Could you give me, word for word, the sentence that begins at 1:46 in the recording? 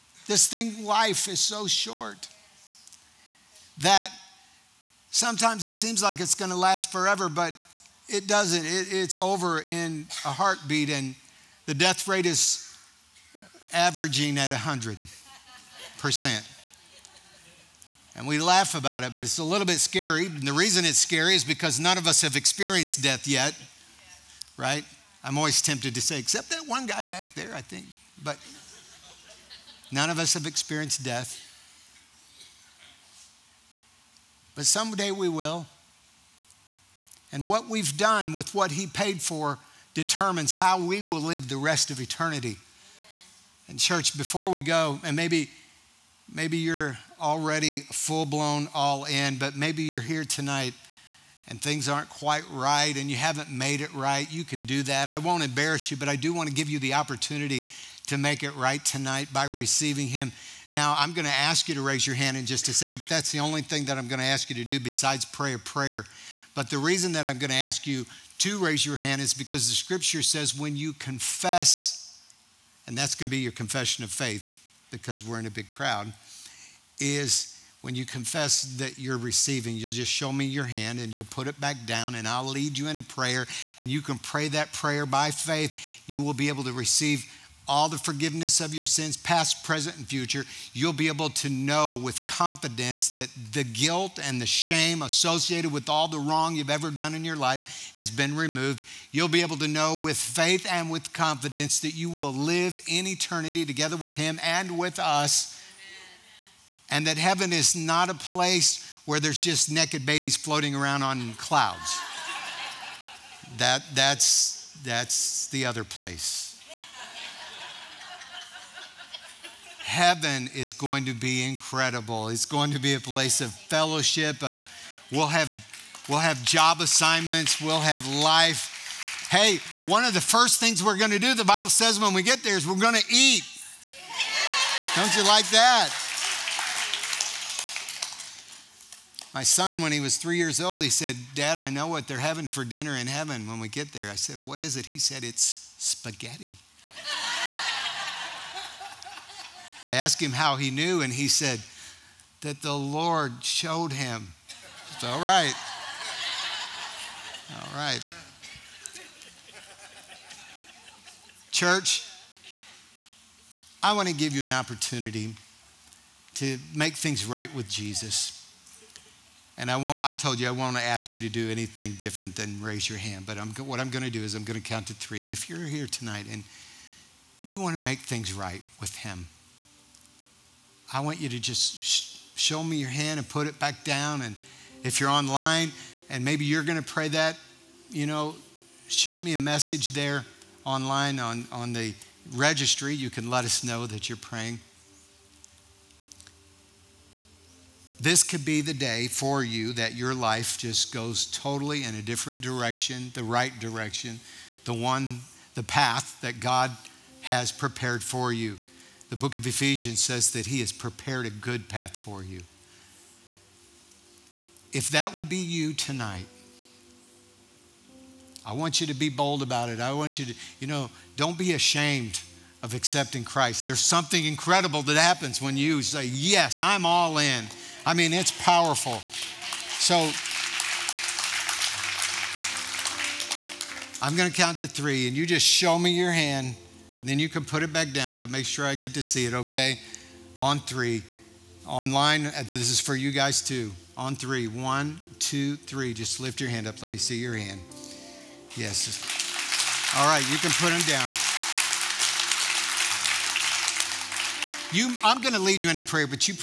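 And that heaven is not a place where there's just naked babies floating around on clouds.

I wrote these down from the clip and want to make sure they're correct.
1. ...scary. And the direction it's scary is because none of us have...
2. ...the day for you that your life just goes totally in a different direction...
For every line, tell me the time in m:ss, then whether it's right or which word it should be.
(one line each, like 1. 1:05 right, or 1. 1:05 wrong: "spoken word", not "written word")
1. 0:19 wrong: "reason", not "direction"
2. 3:18 right.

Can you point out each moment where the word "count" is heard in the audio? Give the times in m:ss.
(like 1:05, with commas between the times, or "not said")
2:54, 3:54.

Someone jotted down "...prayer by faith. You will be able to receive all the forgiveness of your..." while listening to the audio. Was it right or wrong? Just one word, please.
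right.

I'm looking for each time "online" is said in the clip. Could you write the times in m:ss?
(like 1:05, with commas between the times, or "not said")
3:05, 3:10, 4:01.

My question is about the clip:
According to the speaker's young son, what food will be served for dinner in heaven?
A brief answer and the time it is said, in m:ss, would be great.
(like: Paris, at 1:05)
Spaghetti, at 2:25.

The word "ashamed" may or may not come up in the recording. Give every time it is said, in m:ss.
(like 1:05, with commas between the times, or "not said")
3:41.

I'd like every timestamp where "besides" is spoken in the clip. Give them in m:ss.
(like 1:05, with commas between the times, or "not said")
1:04.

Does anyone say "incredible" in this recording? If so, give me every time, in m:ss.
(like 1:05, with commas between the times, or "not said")
2:01, 3:44.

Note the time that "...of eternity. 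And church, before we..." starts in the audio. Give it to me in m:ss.
0:41.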